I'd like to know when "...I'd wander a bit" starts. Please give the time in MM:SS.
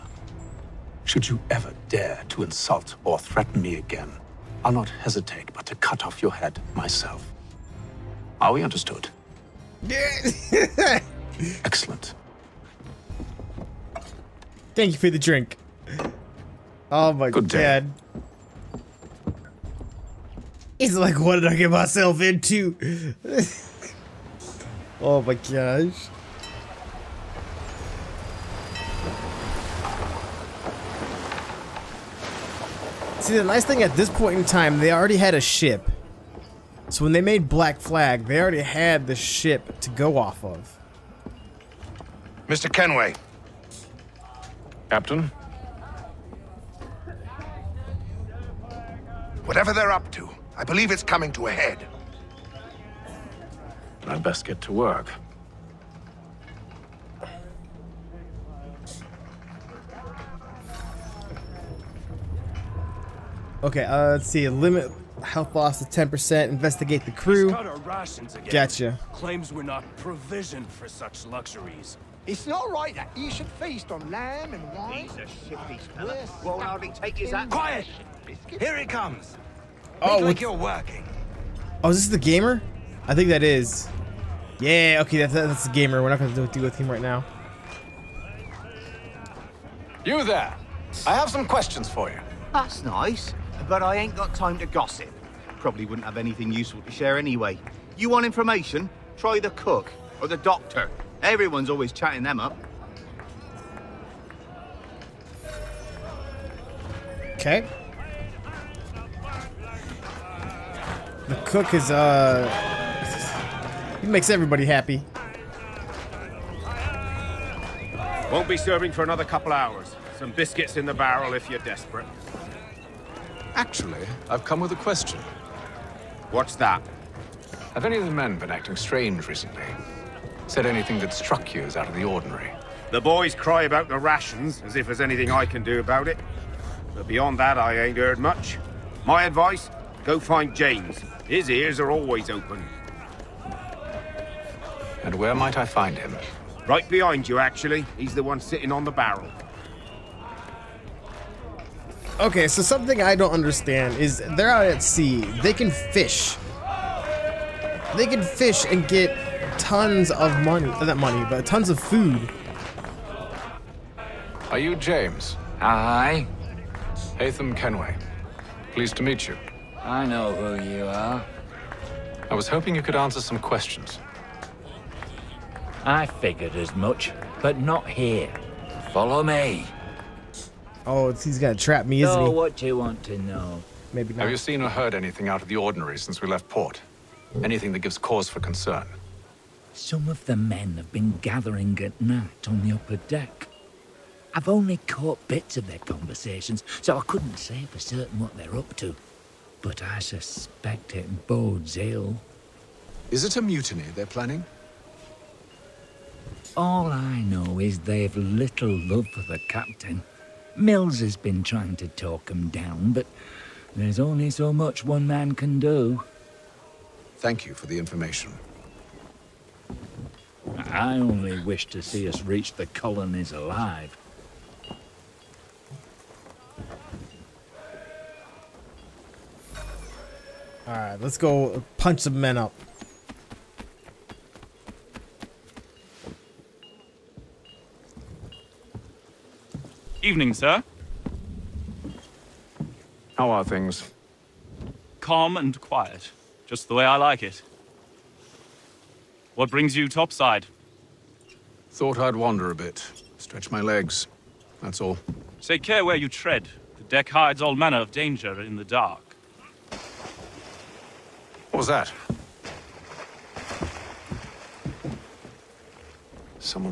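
04:11.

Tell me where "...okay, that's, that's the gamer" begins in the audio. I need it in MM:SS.
01:25.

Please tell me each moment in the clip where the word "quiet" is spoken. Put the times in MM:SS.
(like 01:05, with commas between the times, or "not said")
01:17, 04:05.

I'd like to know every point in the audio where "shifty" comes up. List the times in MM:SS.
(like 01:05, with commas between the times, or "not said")
01:15.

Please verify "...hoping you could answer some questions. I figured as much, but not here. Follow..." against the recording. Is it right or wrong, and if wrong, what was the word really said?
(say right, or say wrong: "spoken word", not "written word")
right.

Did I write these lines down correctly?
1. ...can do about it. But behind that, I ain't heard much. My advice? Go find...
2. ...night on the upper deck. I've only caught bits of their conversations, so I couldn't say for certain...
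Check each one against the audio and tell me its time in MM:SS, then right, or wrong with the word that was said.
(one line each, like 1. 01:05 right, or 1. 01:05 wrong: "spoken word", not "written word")
1. 02:15 wrong: "beyond", not "behind"
2. 03:12 right.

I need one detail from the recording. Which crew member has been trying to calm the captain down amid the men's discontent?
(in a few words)
Mills.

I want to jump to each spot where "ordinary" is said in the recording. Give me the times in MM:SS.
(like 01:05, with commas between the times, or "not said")
02:12, 03:05.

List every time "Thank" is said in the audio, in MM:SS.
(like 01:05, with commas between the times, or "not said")
00:14, 03:37.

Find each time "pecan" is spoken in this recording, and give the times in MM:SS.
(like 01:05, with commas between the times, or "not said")
not said.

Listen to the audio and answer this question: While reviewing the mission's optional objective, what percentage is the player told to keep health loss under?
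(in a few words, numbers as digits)
10%.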